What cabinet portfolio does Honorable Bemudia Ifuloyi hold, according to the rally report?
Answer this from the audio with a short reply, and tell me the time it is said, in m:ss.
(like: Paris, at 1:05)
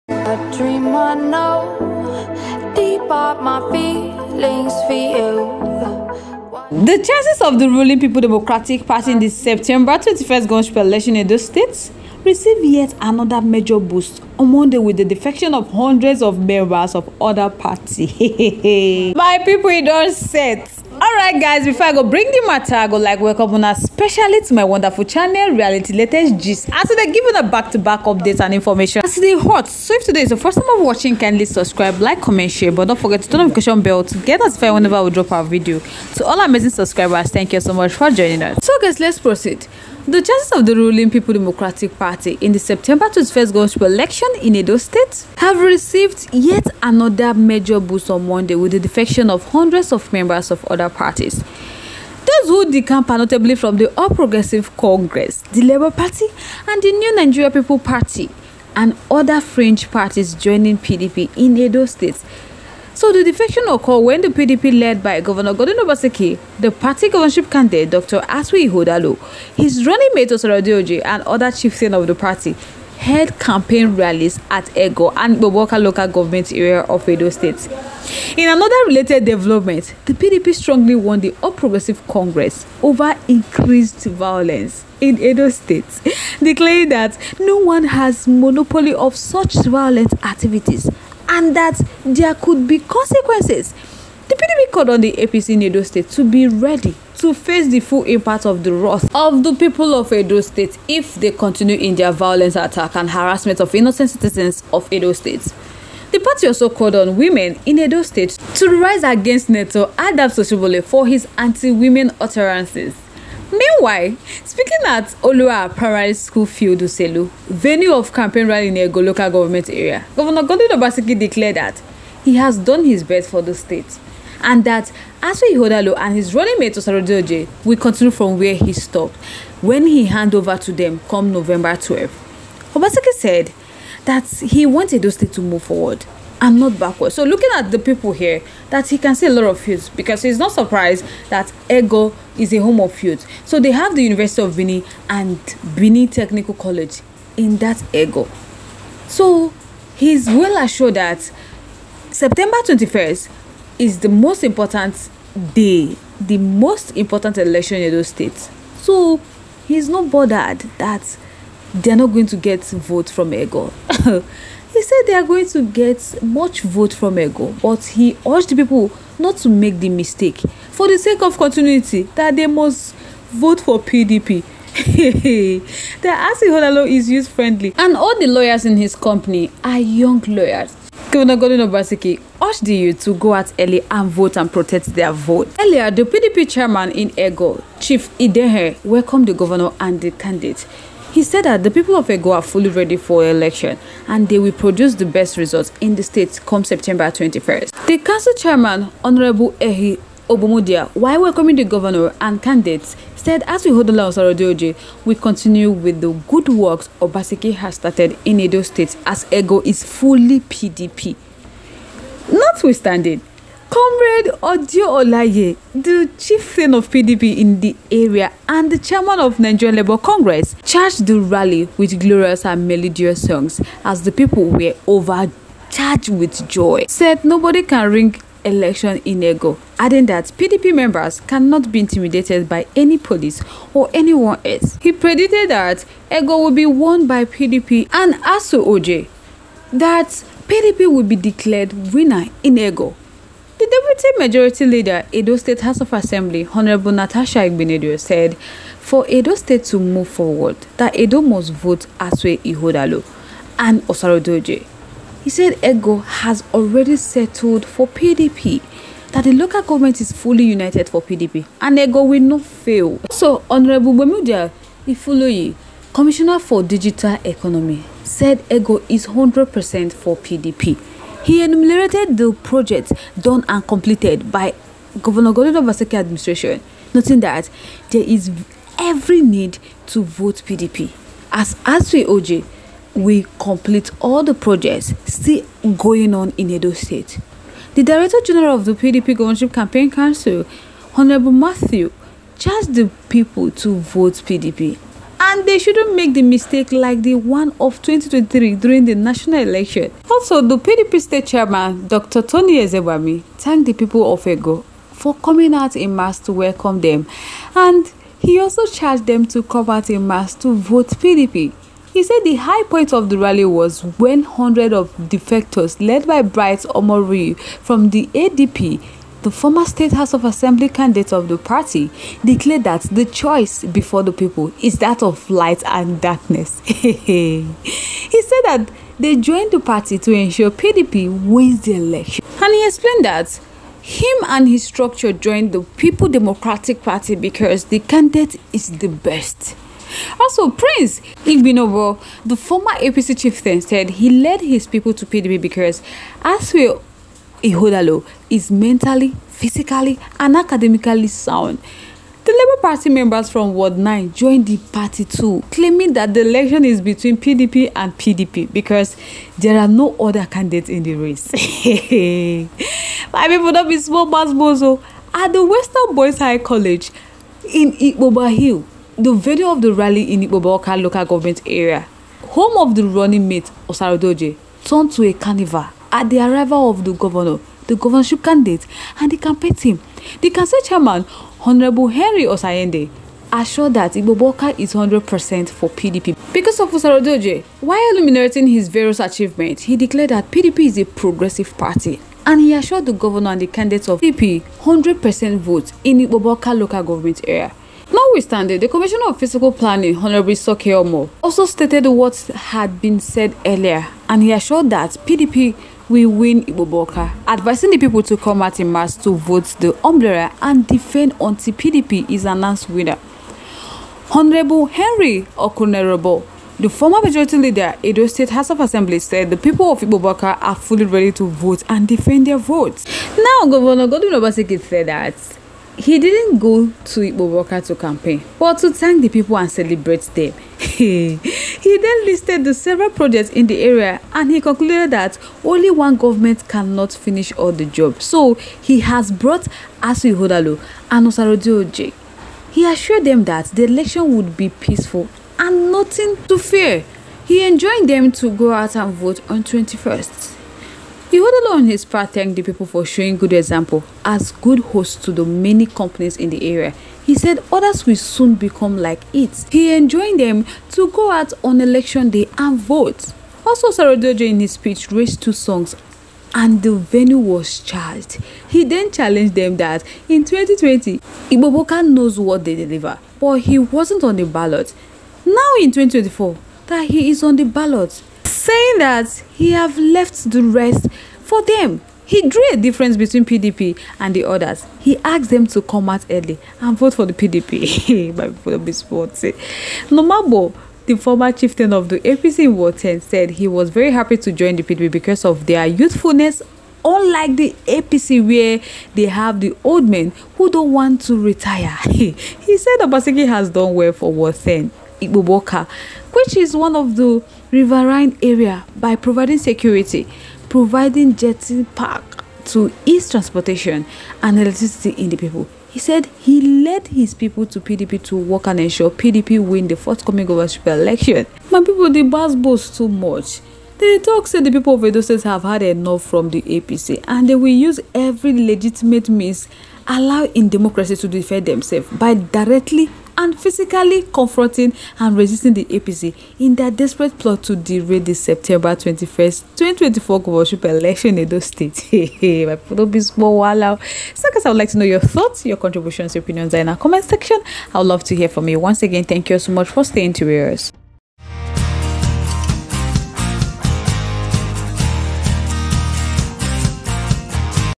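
Digital Economy, at 4:26.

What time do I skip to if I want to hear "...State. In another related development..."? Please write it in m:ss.
1:17.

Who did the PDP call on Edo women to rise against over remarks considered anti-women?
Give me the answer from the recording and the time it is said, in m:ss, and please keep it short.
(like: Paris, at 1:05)
Neto Adam Soshibole, at 1:49.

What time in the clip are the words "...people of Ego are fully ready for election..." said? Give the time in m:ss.
3:11.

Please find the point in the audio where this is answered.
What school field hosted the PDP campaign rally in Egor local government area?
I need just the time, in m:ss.
1:55.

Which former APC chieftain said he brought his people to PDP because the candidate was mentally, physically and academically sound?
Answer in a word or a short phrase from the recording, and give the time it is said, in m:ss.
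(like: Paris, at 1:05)
Prince Igbinovo, at 5:40.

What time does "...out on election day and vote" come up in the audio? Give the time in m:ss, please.
7:41.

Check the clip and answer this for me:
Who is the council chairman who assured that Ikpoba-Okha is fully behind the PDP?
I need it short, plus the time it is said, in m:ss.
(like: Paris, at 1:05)
Henry Osayende, at 6:21.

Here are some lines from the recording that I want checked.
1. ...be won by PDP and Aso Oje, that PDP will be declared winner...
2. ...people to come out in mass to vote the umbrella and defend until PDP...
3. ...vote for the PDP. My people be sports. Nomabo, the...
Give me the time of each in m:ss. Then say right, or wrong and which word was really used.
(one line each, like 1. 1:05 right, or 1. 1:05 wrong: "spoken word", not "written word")
1. 3:56 right
2. 6:47 right
3. 8:06 right.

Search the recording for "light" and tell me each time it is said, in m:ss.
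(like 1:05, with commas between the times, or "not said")
5:25.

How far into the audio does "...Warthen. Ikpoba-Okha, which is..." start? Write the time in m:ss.
8:24.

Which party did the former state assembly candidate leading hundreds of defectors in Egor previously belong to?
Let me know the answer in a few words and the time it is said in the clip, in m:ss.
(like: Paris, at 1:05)
ADP, at 5:18.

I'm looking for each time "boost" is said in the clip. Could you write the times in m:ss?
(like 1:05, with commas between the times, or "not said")
0:13, 0:47.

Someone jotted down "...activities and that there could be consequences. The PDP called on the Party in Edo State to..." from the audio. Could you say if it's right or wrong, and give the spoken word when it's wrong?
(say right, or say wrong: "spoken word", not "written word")
wrong: "APC", not "Party".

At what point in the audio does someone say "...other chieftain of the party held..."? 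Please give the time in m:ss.
1:11.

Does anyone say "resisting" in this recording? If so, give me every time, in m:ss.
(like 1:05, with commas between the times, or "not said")
8:55.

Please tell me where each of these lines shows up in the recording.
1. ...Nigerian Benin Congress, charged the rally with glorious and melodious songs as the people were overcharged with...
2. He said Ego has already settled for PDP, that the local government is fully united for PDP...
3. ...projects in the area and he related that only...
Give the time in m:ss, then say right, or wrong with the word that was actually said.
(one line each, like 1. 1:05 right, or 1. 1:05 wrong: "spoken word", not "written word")
1. 3:39 wrong: "Labour", not "Benin"
2. 4:15 right
3. 7:12 wrong: "concluded", not "related".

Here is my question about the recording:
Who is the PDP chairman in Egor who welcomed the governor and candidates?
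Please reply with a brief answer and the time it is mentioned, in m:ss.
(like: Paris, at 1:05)
Chief Idehe, at 3:07.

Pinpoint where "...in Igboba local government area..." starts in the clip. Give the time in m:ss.
6:10.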